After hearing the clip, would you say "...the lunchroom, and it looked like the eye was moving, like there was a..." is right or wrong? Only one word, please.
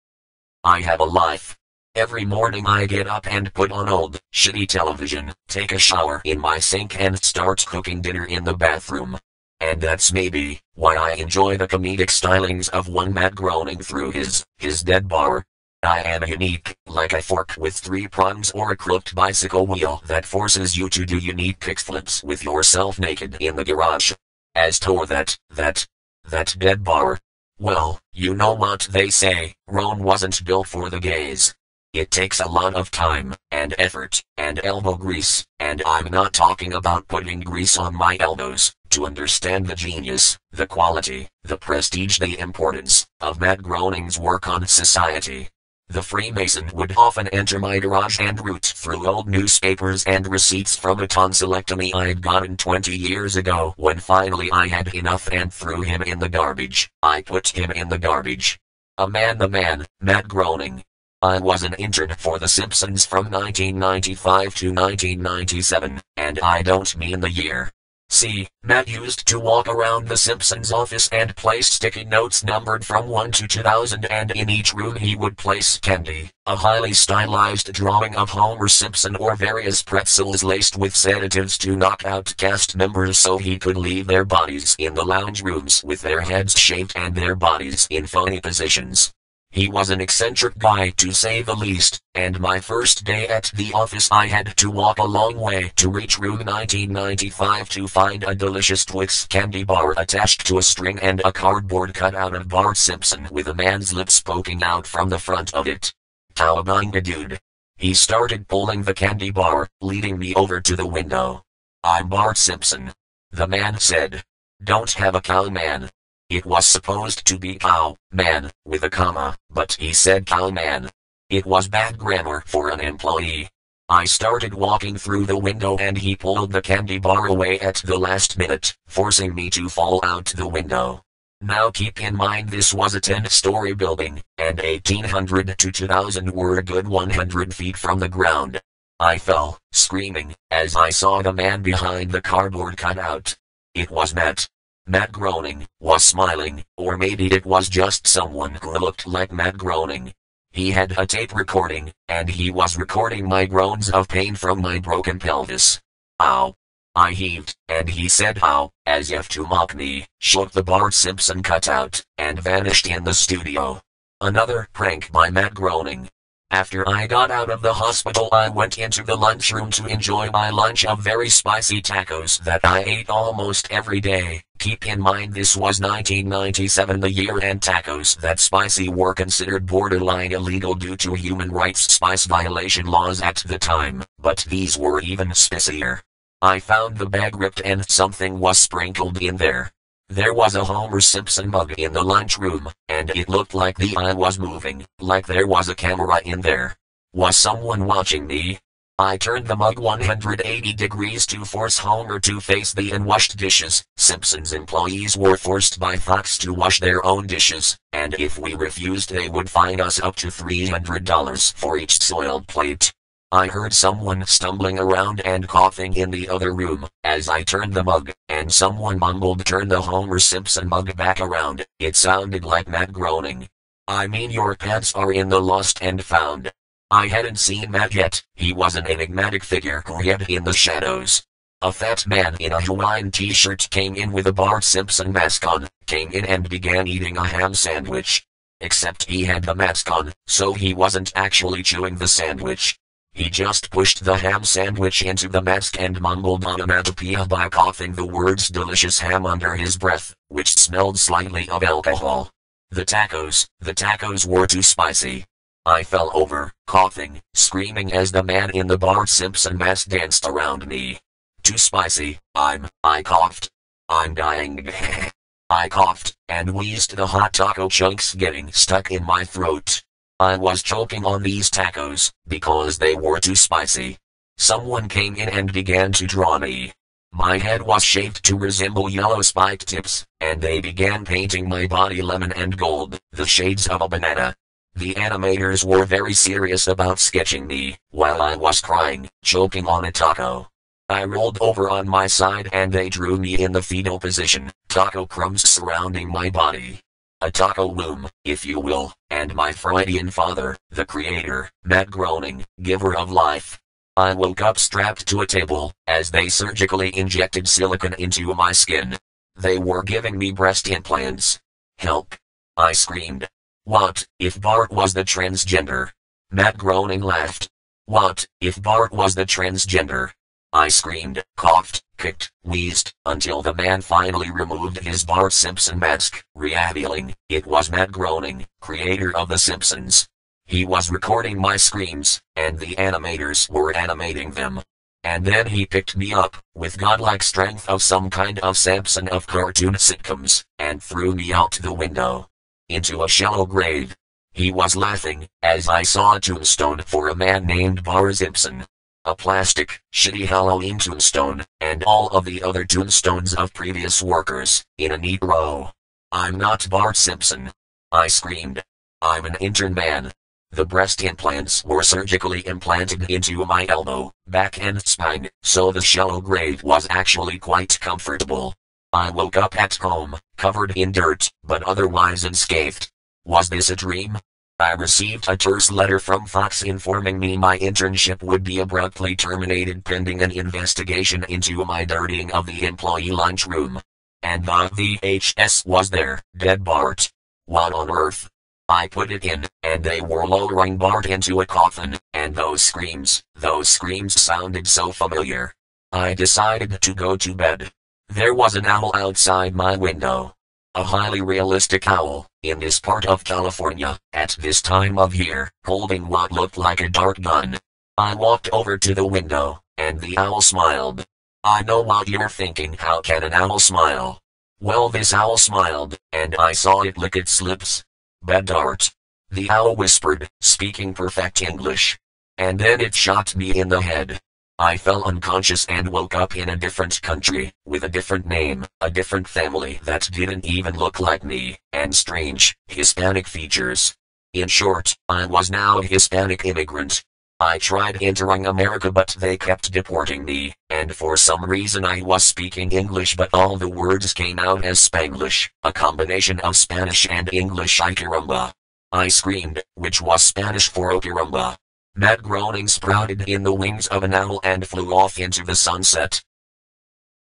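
right.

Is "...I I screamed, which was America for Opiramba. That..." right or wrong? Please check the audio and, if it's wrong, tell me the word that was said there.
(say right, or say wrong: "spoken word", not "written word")
wrong: "Spanish", not "America".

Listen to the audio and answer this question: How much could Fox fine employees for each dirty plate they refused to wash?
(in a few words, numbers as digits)
$300.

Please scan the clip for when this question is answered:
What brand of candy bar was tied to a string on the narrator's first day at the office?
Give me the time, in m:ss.
1:38.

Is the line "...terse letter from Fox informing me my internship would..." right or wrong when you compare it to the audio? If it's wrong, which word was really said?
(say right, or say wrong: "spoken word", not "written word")
right.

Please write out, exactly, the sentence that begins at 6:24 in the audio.
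And the VHS was there, dead Bart.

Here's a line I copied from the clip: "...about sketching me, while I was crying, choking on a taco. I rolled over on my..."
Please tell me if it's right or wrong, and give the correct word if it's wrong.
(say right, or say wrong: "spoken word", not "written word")
right.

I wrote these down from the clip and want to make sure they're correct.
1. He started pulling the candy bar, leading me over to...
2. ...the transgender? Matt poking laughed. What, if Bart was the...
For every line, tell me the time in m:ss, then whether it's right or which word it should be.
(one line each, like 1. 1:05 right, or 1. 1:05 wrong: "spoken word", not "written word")
1. 1:47 right
2. 5:14 wrong: "groaning", not "poking".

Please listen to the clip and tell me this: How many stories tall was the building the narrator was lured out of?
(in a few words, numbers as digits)
10.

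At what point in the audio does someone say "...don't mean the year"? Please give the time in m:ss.
1:06.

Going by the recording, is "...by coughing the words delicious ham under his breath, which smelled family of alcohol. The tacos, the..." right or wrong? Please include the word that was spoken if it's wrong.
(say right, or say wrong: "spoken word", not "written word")
wrong: "slightly", not "family".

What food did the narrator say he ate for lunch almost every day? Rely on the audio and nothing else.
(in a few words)
Very spicy tacos.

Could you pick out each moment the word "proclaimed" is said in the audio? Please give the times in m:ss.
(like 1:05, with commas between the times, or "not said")
not said.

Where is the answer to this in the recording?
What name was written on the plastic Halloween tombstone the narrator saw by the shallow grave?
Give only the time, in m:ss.
5:47.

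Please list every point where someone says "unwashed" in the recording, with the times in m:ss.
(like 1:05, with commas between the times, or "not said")
3:22.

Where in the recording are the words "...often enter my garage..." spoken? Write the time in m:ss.
0:46.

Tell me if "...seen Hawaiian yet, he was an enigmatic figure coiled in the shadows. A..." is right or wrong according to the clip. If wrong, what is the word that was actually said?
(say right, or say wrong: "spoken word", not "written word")
wrong: "Matt", not "Hawaiian".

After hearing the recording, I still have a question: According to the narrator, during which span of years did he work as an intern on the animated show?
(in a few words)
1995 to 1997.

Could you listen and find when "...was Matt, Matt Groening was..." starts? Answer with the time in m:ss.
2:23.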